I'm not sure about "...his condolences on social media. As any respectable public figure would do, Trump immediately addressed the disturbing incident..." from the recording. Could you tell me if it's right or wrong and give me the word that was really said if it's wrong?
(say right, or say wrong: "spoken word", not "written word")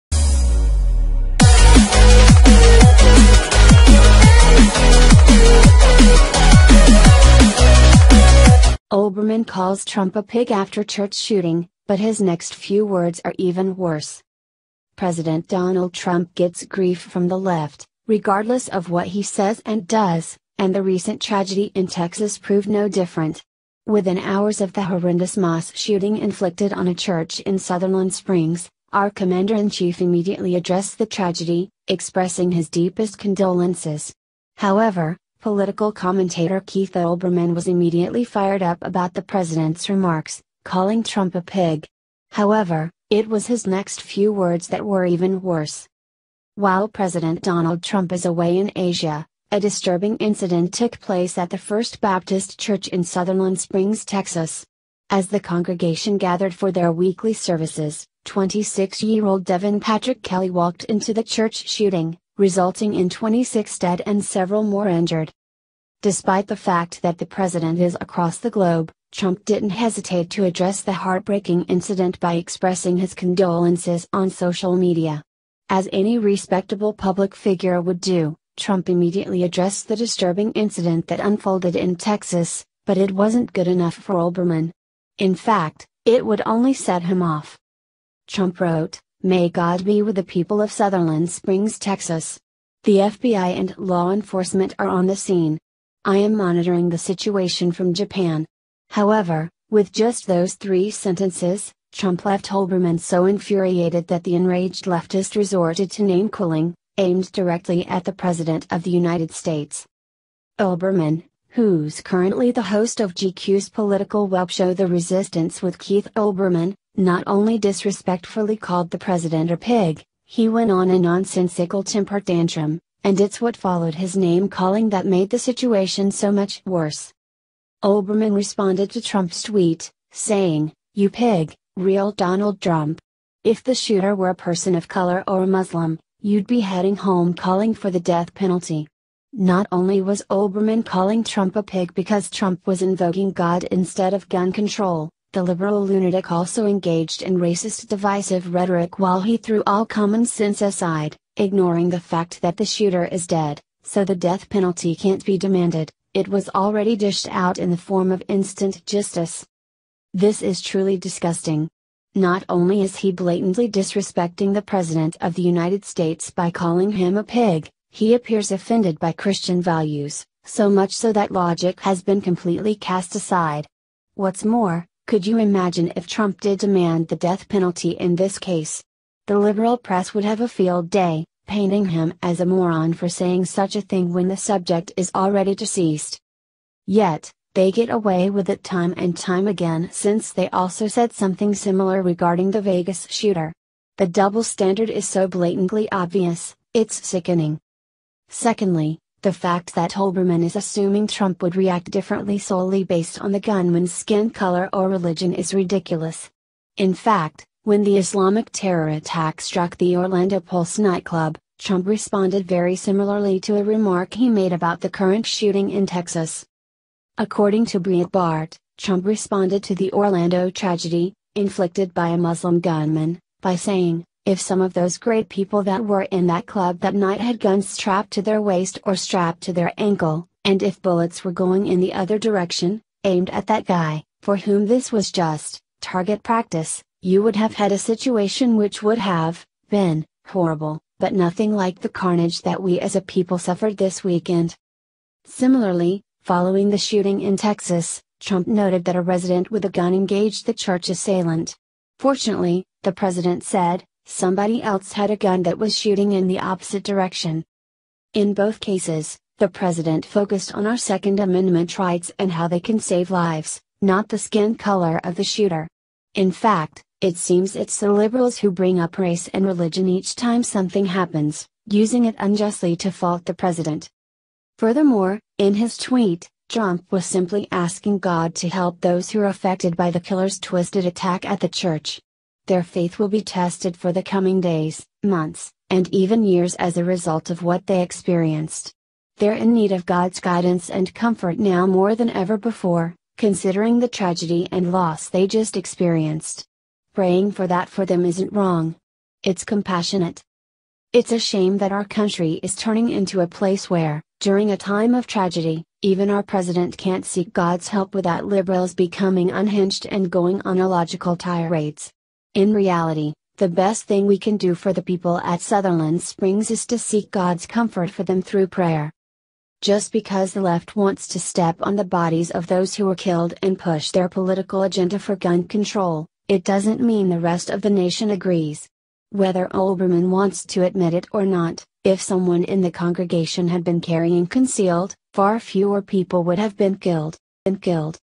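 right.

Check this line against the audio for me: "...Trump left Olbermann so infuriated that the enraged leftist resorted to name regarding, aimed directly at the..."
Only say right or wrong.
wrong.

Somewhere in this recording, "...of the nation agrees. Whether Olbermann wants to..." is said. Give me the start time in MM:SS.
05:27.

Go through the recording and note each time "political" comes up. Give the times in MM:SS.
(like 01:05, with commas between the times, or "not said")
00:35, 01:53, 05:24.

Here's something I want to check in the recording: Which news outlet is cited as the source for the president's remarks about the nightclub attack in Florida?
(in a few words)
Breitbart.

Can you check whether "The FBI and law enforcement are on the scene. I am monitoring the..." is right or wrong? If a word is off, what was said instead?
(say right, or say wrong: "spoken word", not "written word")
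right.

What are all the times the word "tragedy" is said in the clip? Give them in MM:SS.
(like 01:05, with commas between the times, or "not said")
00:21, 00:31, 03:40, 04:53, 05:05.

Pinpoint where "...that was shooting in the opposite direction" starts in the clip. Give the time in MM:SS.
04:15.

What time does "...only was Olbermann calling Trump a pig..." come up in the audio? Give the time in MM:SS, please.
02:19.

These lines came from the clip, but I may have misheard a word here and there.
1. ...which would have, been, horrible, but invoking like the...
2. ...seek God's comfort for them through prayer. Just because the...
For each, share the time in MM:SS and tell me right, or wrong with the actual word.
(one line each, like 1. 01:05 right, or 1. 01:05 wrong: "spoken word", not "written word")
1. 03:58 wrong: "nothing", not "invoking"
2. 05:16 right.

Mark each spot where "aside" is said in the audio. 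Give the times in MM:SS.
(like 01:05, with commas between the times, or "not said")
02:30, 02:53.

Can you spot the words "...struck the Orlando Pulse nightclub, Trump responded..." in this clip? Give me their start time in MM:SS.
03:29.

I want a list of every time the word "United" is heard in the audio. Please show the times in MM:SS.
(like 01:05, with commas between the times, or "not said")
01:48, 02:45.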